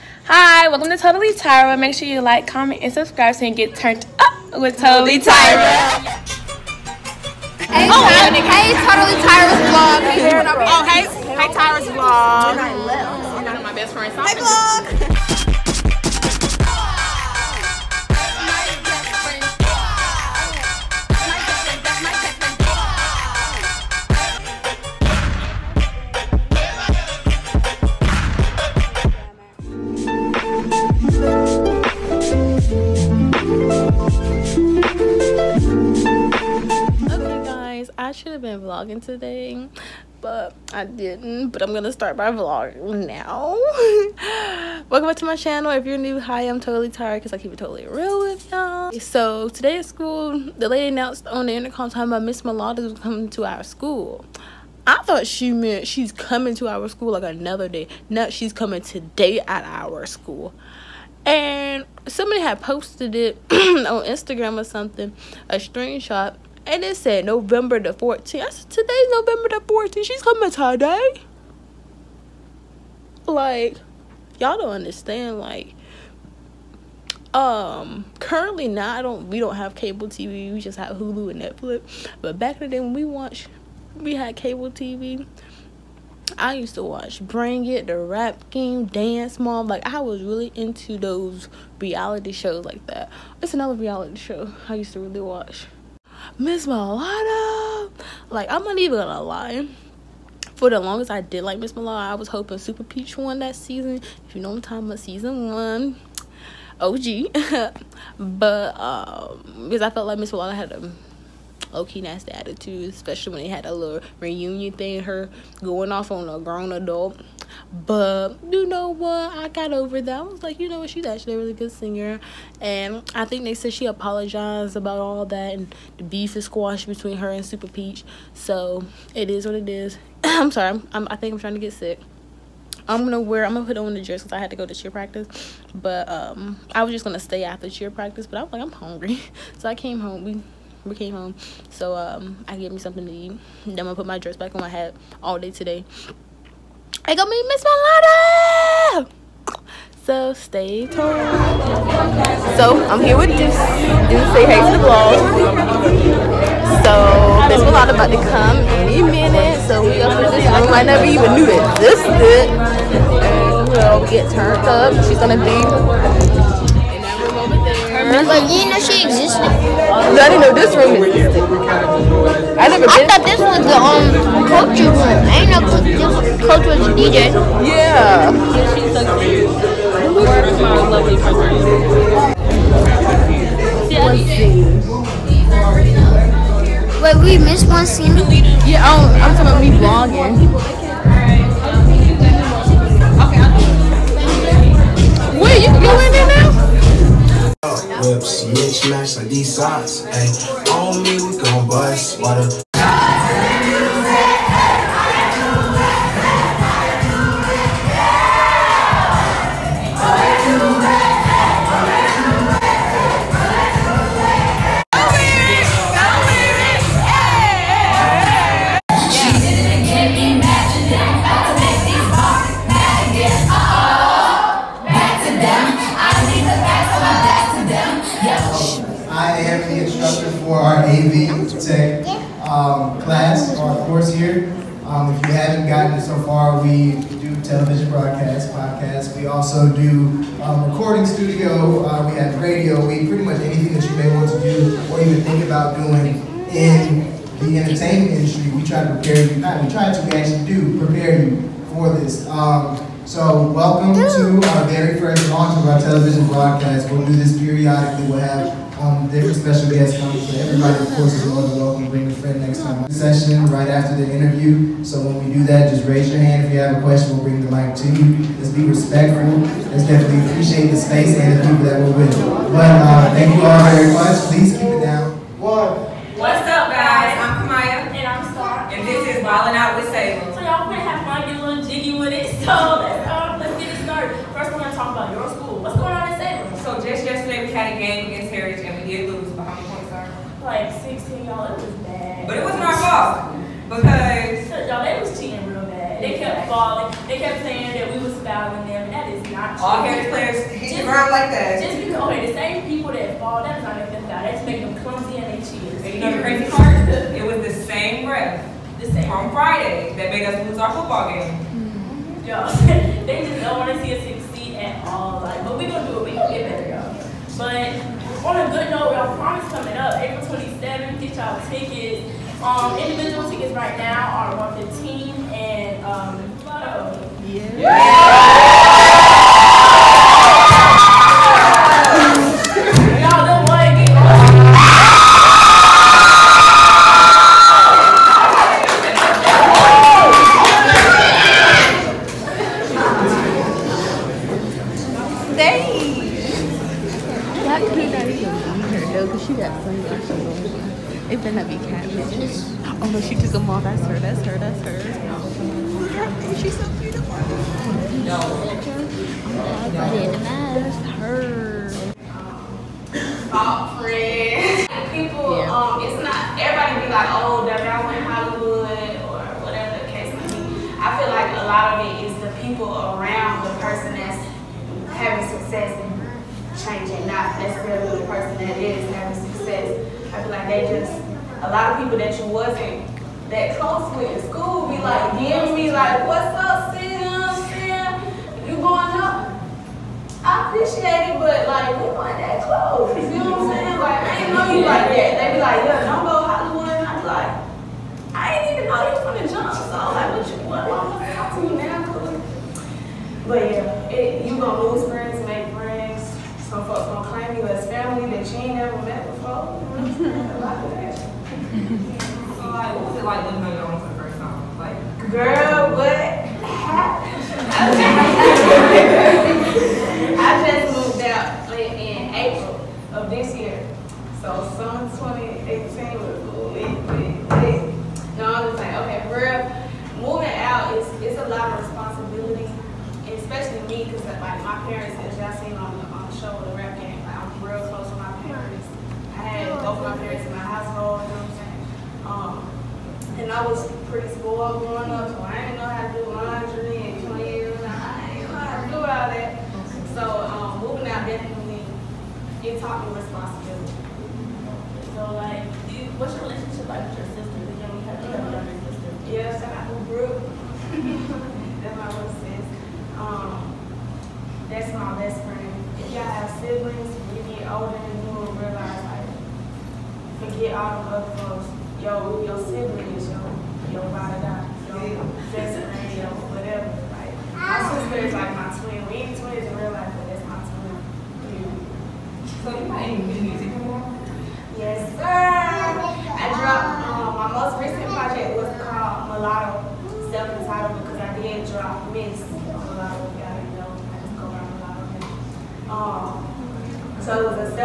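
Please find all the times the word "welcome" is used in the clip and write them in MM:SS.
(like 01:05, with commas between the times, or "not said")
00:00, 00:44, 04:13, 04:21.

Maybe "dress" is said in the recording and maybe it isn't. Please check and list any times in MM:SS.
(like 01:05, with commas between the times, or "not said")
02:14, 02:24.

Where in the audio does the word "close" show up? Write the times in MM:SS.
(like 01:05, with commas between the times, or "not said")
06:23, 06:32.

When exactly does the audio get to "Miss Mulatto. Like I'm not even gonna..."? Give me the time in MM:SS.
01:36.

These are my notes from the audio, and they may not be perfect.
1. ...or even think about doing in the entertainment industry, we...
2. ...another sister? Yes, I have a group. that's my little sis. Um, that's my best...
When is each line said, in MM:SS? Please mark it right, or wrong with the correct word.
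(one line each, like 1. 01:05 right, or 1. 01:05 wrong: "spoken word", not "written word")
1. 04:04 right
2. 07:37 right.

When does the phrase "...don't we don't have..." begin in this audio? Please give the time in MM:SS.
01:19.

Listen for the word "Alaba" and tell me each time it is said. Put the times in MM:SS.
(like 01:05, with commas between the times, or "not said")
not said.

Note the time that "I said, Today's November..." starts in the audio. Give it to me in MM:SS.
01:08.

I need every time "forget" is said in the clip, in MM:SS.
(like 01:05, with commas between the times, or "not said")
07:50.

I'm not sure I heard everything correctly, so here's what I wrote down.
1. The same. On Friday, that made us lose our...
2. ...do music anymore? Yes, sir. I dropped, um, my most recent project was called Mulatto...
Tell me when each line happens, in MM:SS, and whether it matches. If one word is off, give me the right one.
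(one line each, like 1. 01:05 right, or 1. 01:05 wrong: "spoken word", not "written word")
1. 05:08 right
2. 08:03 right.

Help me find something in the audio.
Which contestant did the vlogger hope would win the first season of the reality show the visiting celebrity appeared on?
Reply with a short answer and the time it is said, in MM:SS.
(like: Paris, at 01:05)
Supa Peach, at 01:42.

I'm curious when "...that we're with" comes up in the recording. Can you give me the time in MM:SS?
04:31.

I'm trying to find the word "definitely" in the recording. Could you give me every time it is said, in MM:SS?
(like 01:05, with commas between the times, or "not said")
04:29, 07:31.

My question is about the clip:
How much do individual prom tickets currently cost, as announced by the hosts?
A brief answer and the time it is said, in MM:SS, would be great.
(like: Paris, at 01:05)
115, at 05:24.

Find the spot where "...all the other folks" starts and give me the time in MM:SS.
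07:50.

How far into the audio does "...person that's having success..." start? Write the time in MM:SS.
06:13.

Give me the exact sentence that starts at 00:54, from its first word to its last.
I thought she meant she's coming to our school like another day.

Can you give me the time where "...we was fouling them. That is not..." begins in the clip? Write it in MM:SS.
04:57.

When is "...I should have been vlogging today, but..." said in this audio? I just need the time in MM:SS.
00:37.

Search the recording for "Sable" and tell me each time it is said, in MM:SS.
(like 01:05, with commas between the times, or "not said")
04:39, 04:46.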